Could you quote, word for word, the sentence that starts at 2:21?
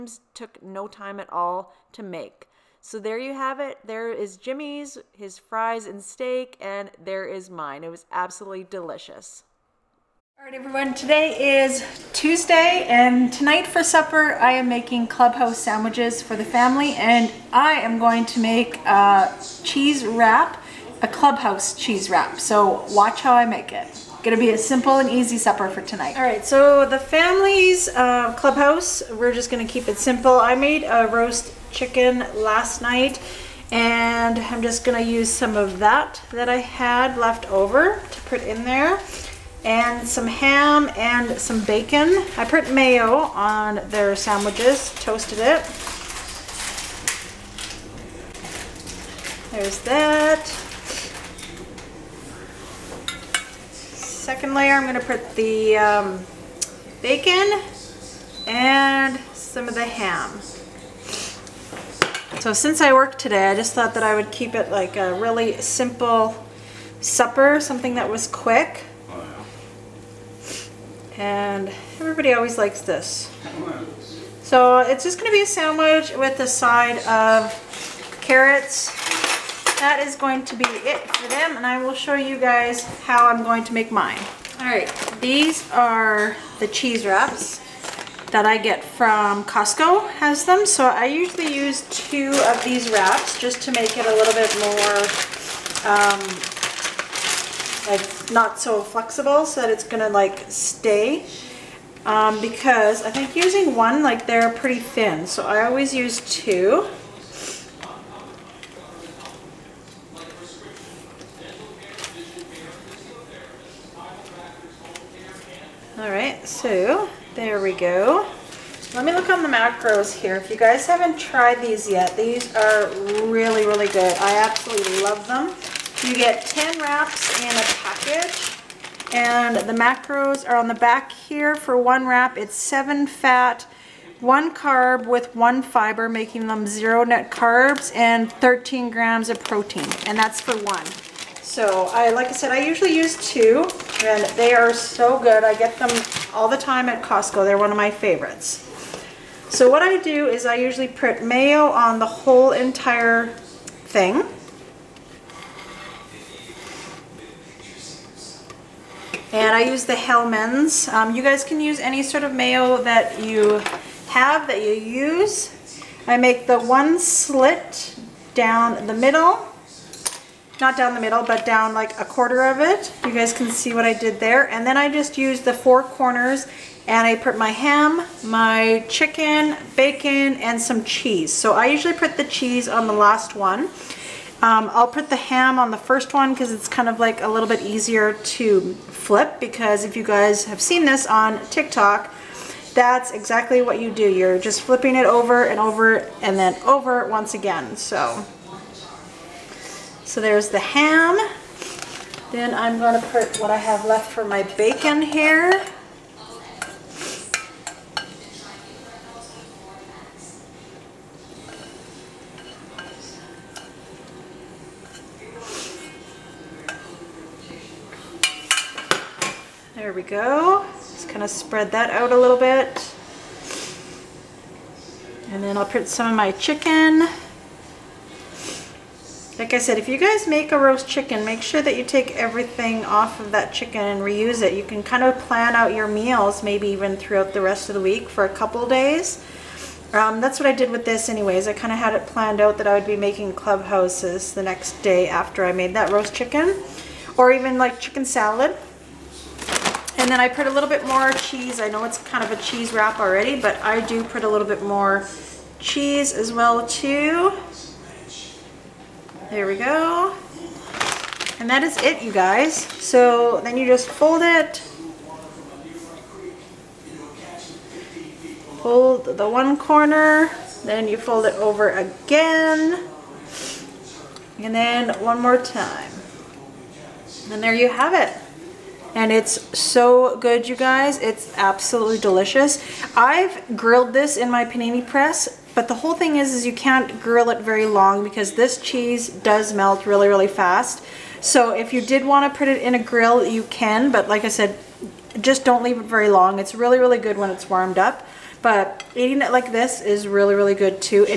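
So I, like I said, I usually use two and they are so good.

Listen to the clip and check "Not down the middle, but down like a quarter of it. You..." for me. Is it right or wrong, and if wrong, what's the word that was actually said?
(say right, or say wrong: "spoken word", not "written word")
right.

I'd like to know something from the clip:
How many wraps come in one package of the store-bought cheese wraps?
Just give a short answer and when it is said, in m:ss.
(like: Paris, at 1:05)
10, at 2:06.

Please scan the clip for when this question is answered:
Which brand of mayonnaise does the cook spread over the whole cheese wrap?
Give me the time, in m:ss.
2:39.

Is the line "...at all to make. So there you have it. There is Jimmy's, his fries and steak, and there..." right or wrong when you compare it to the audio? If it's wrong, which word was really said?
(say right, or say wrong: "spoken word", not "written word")
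right.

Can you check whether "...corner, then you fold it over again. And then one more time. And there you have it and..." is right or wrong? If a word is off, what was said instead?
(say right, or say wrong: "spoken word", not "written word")
right.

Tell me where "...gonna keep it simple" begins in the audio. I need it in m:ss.
0:29.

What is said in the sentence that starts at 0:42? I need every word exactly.
I put mayo on their sandwiches, toasted it.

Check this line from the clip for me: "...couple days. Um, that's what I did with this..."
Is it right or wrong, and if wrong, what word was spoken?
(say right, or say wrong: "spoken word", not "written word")
right.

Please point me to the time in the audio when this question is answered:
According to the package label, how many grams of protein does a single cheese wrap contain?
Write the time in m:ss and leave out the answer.
2:18.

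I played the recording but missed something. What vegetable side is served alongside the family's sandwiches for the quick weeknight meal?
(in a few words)
Carrots.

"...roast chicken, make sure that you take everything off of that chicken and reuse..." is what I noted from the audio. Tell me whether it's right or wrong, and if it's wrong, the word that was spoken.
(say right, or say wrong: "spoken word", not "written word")
right.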